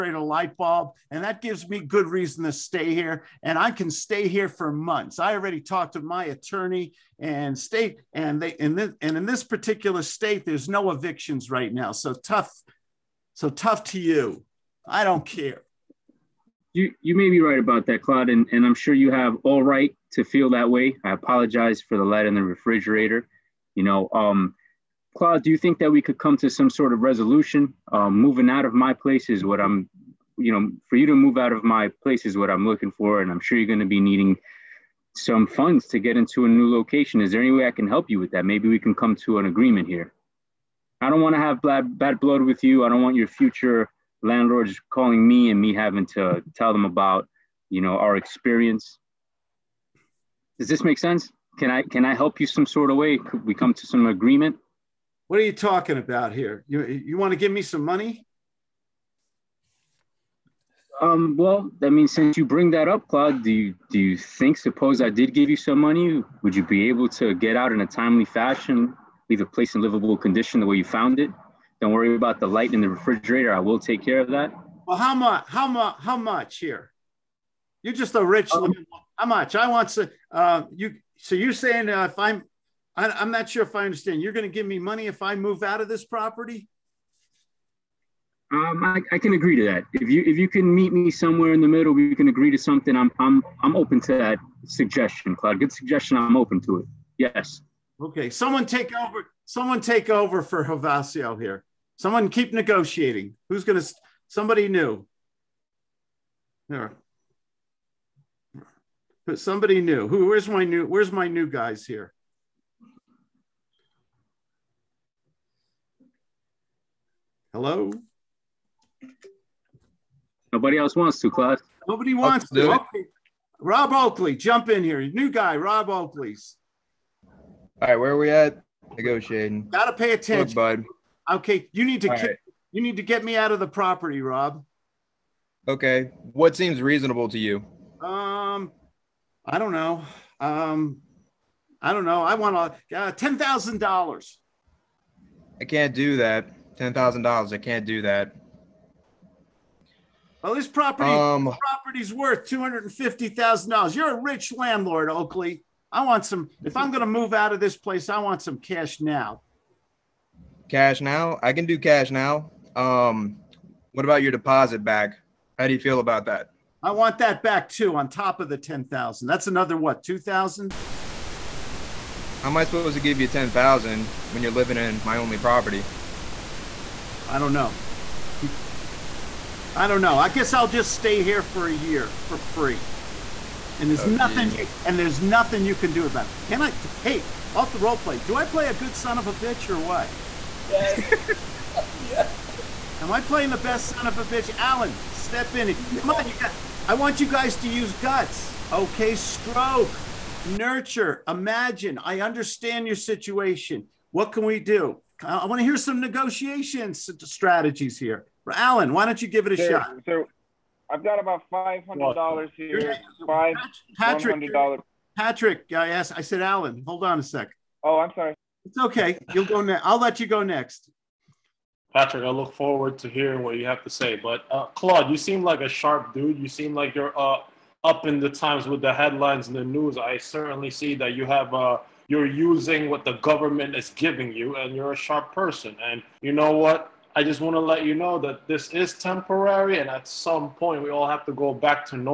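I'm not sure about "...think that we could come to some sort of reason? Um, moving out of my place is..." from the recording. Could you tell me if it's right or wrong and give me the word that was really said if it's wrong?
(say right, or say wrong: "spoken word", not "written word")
wrong: "resolution", not "reason".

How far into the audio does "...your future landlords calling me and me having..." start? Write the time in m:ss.
0:43.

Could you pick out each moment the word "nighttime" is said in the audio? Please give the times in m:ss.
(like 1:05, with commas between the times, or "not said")
not said.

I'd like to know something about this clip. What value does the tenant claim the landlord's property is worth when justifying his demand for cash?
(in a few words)
$250,000.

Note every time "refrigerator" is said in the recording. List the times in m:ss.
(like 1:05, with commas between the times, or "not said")
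0:22, 1:12.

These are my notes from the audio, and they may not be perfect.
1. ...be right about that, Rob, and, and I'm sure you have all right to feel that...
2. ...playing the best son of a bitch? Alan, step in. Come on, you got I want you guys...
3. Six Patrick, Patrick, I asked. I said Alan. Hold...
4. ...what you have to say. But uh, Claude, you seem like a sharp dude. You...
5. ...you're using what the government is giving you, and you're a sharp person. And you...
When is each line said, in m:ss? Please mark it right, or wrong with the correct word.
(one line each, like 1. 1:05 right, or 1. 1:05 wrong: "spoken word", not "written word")
1. 0:17 wrong: "Claude", not "Rob"
2. 3:13 right
3. 3:33 wrong: "Five", not "Six"
4. 3:43 right
5. 3:52 right.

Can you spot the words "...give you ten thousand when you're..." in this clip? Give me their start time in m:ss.
2:52.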